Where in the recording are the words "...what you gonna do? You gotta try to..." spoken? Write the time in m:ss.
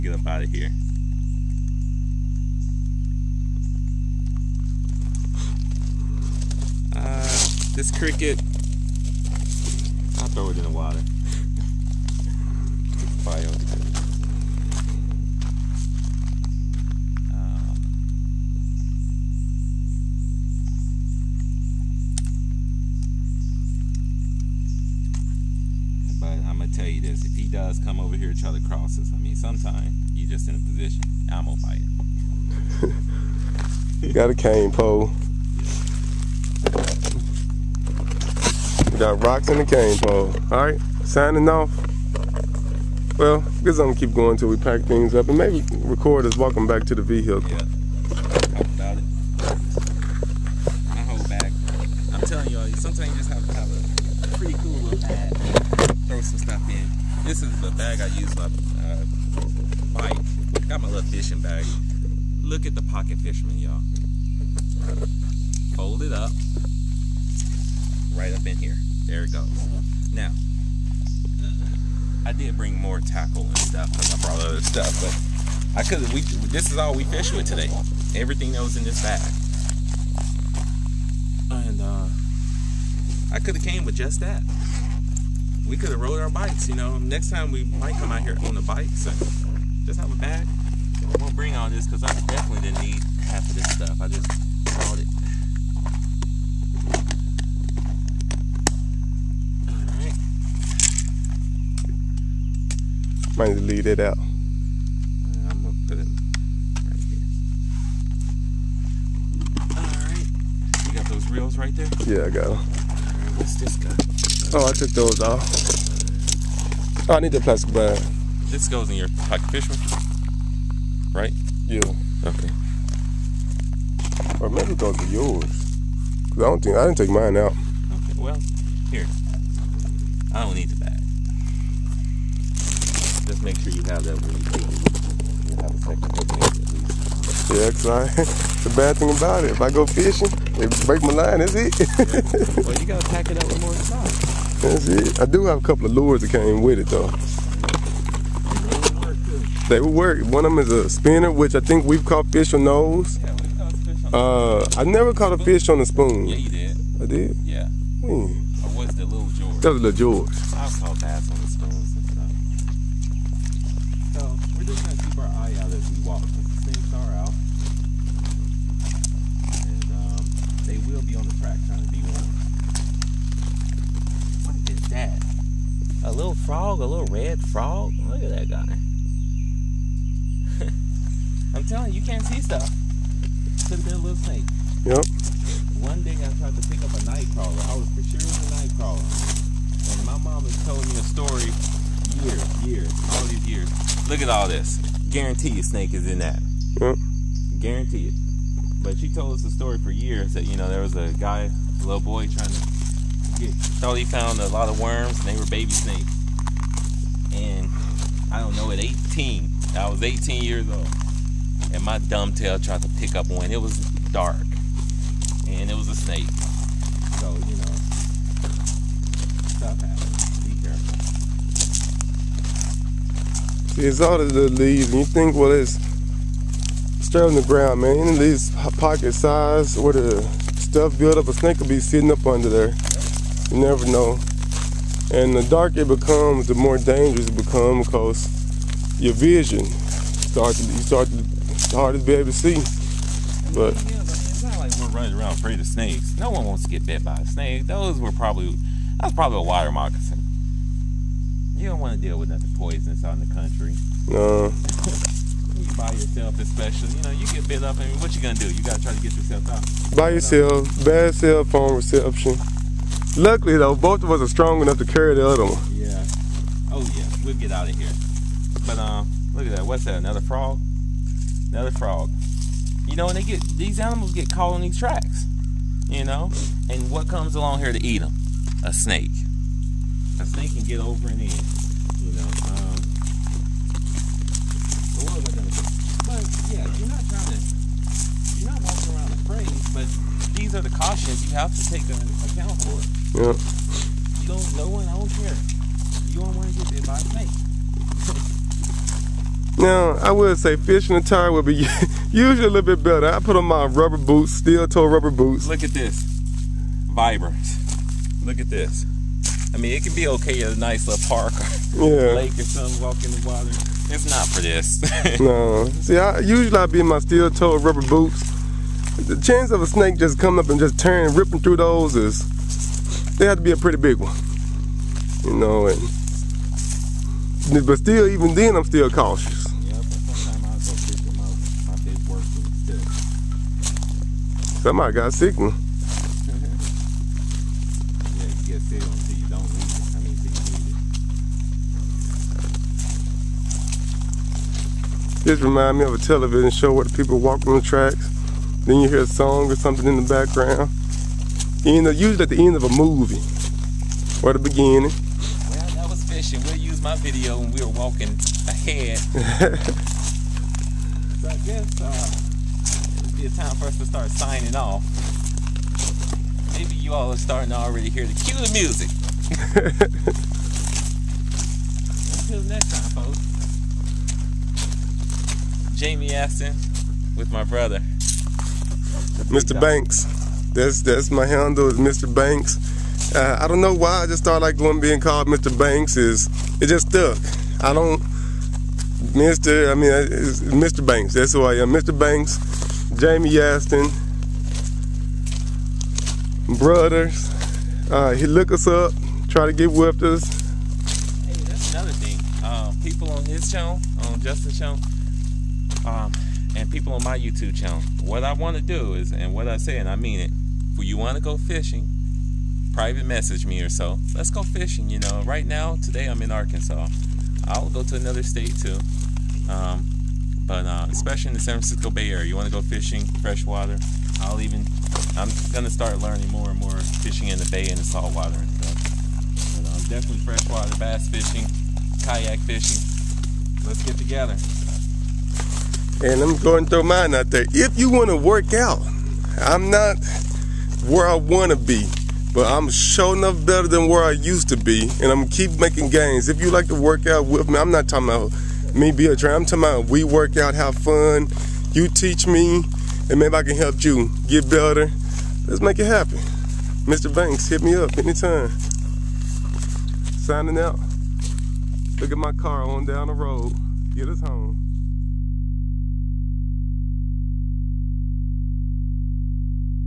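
4:18.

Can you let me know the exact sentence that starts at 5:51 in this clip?
You know, usually at the end of a movie or the beginning.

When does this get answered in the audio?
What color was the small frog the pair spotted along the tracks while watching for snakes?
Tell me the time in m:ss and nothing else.
2:57.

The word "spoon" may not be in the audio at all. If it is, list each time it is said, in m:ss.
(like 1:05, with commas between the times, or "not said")
2:35, 2:41.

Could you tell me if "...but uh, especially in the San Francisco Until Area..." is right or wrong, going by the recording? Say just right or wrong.
wrong.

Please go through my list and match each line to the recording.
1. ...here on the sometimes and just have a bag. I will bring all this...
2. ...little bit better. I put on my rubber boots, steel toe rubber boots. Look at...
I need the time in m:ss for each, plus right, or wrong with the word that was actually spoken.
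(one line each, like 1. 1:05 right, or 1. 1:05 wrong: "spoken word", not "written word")
1. 1:28 wrong: "bikes", not "sometimes"
2. 5:02 right.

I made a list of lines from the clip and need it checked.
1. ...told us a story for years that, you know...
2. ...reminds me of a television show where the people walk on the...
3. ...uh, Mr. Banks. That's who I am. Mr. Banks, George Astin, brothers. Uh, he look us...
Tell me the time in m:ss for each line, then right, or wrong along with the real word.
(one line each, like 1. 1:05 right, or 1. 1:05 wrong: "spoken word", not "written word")
1. 3:19 right
2. 5:45 right
3. 6:29 wrong: "Jaime", not "George".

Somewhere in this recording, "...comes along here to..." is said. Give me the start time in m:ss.
4:37.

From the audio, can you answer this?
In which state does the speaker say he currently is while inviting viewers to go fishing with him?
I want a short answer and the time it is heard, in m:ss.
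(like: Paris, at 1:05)
Arkansas, at 6:56.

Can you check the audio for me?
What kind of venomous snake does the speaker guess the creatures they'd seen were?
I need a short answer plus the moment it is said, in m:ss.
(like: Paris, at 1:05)
water moccasin, at 4:09.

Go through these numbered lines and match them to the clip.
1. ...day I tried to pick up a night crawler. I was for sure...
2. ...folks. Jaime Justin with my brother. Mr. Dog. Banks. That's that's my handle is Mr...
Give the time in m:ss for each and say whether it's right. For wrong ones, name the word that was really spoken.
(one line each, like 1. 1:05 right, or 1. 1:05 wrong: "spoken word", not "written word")
1. 3:06 right
2. 6:13 wrong: "Astin", not "Justin".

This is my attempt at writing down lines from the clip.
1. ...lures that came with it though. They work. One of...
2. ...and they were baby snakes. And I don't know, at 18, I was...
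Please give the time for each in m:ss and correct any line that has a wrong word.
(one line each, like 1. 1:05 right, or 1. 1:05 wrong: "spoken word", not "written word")
1. 2:25 right
2. 3:25 right.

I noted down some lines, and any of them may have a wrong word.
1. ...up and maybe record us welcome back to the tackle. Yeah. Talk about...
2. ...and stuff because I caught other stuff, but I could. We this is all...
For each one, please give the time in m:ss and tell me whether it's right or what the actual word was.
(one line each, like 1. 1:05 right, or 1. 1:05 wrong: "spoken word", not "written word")
1. 0:45 wrong: "vehicle", not "tackle"
2. 1:13 wrong: "brought", not "caught".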